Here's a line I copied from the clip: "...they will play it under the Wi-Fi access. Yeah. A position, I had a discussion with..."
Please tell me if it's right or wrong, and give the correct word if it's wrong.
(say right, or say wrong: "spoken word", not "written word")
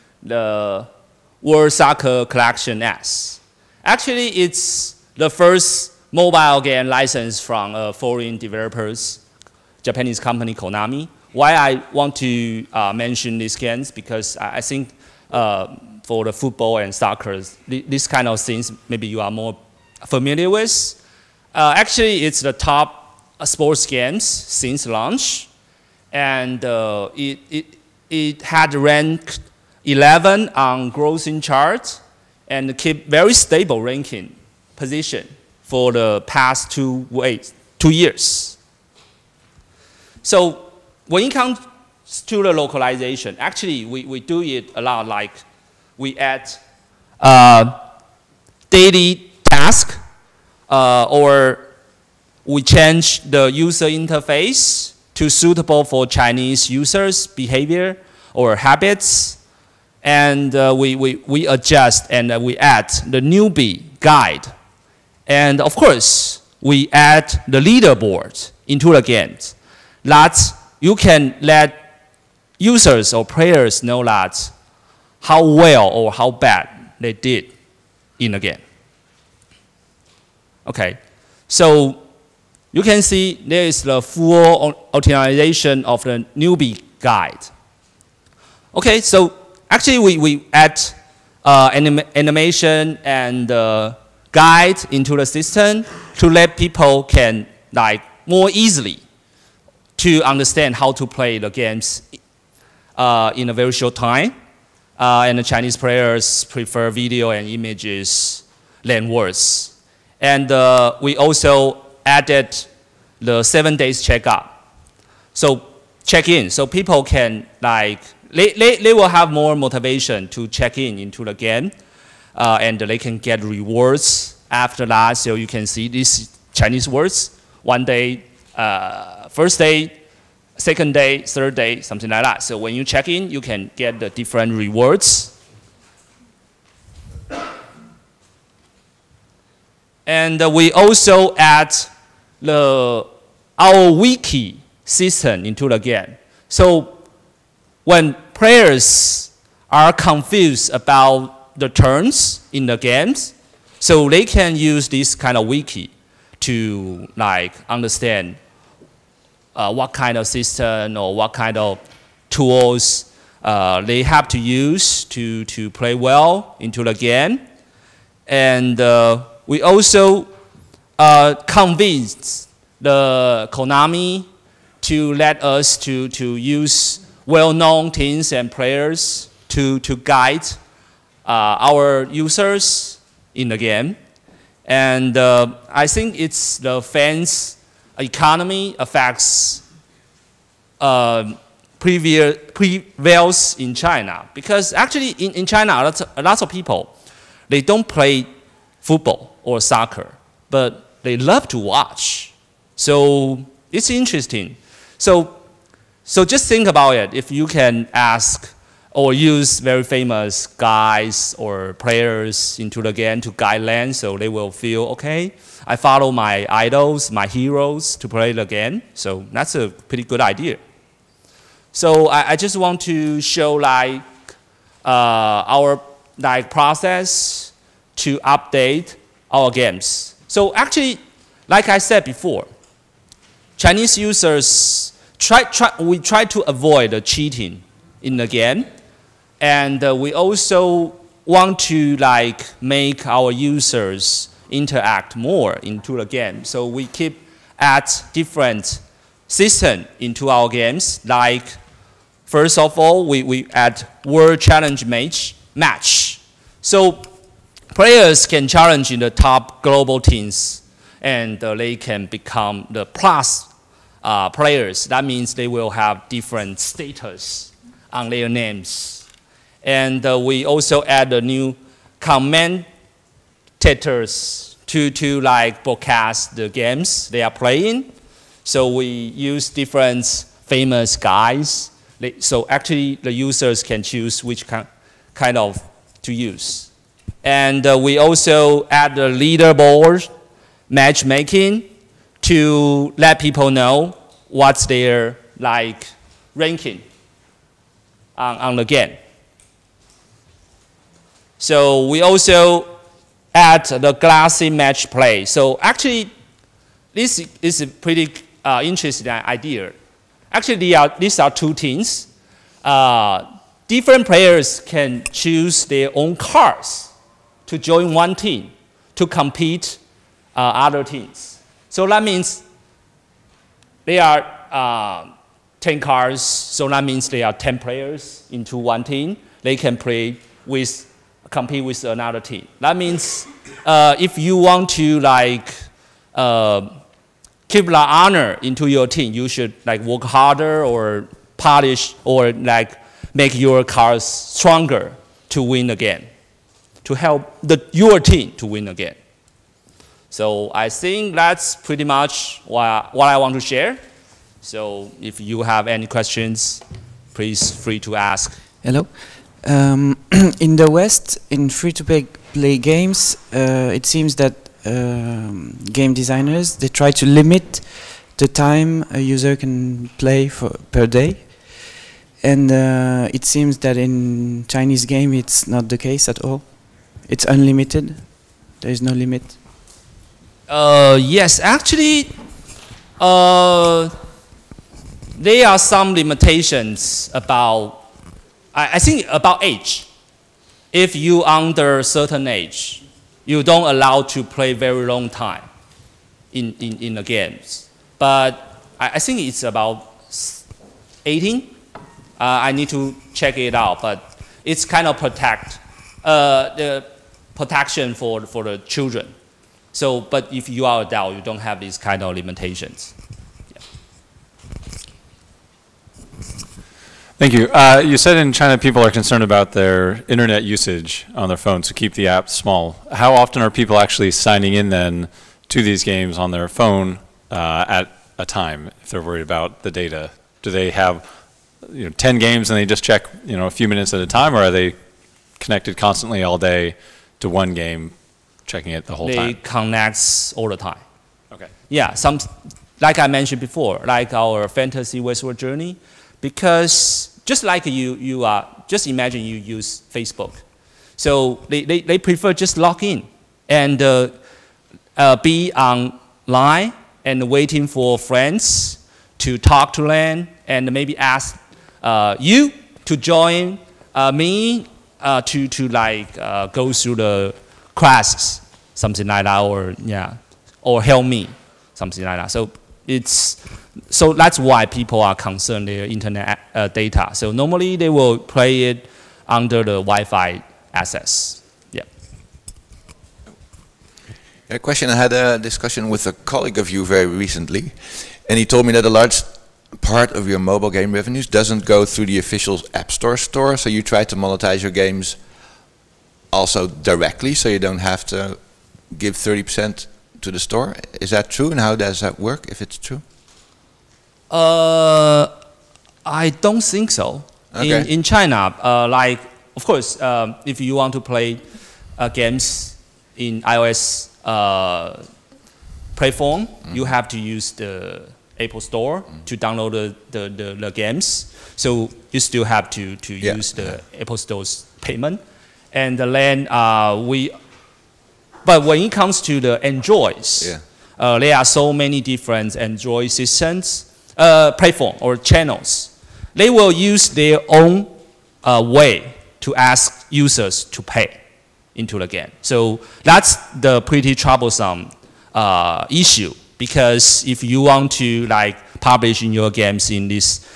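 wrong: "question", not "position".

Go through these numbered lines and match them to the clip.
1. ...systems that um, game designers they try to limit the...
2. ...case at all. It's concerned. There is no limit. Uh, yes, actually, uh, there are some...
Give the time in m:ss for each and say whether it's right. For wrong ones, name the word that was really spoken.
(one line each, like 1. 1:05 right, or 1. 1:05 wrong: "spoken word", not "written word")
1. 6:03 wrong: "seems", not "systems"
2. 6:15 wrong: "unlimited", not "concerned".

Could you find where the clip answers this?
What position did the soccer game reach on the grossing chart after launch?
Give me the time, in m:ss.
0:29.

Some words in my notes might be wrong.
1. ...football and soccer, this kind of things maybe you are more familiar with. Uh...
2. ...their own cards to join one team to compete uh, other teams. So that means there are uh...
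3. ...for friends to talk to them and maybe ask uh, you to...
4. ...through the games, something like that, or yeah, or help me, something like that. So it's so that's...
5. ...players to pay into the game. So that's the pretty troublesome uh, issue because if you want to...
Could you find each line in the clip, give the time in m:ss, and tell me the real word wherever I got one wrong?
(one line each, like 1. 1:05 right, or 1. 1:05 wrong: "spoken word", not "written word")
1. 0:16 right
2. 5:15 right
3. 7:37 right
4. 7:46 wrong: "classes", not "games"
5. 9:00 wrong: "users", not "players".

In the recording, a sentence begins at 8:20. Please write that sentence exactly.
Is that true, and how does that work, if it's true?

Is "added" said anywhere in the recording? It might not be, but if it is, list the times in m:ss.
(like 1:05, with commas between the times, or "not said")
1:52.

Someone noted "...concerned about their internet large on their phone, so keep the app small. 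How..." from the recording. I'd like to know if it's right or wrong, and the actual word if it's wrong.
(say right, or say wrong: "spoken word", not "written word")
wrong: "usage", not "large".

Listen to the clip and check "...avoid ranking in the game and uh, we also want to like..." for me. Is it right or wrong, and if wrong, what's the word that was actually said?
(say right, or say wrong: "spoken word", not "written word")
wrong: "cheating", not "ranking".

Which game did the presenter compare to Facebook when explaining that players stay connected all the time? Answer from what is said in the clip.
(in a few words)
Fantasy Westward Journey.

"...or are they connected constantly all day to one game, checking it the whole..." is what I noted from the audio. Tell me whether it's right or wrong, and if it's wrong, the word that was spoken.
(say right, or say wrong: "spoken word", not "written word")
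right.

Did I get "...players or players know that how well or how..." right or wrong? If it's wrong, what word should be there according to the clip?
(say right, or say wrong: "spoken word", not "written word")
wrong: "users", not "players".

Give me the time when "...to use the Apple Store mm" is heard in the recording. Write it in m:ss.
8:37.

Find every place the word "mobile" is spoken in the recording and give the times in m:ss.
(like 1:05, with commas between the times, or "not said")
0:06, 8:10.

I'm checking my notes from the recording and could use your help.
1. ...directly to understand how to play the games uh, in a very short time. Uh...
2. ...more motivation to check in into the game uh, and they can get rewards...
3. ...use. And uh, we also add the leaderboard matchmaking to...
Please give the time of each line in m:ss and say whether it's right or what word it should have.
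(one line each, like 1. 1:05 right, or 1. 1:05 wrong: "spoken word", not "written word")
1. 1:38 wrong: "easily", not "directly"
2. 1:59 right
3. 4:46 right.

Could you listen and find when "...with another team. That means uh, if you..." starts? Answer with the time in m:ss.
5:31.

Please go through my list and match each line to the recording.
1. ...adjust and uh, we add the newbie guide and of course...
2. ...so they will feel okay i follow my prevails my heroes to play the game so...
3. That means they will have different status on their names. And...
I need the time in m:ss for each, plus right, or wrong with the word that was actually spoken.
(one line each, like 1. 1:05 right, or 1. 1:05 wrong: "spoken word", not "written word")
1. 1:01 right
2. 3:33 wrong: "idols", not "prevails"
3. 4:24 right.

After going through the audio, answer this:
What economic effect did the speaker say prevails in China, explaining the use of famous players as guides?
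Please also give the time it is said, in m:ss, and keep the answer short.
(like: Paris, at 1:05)
Fans economy, at 3:06.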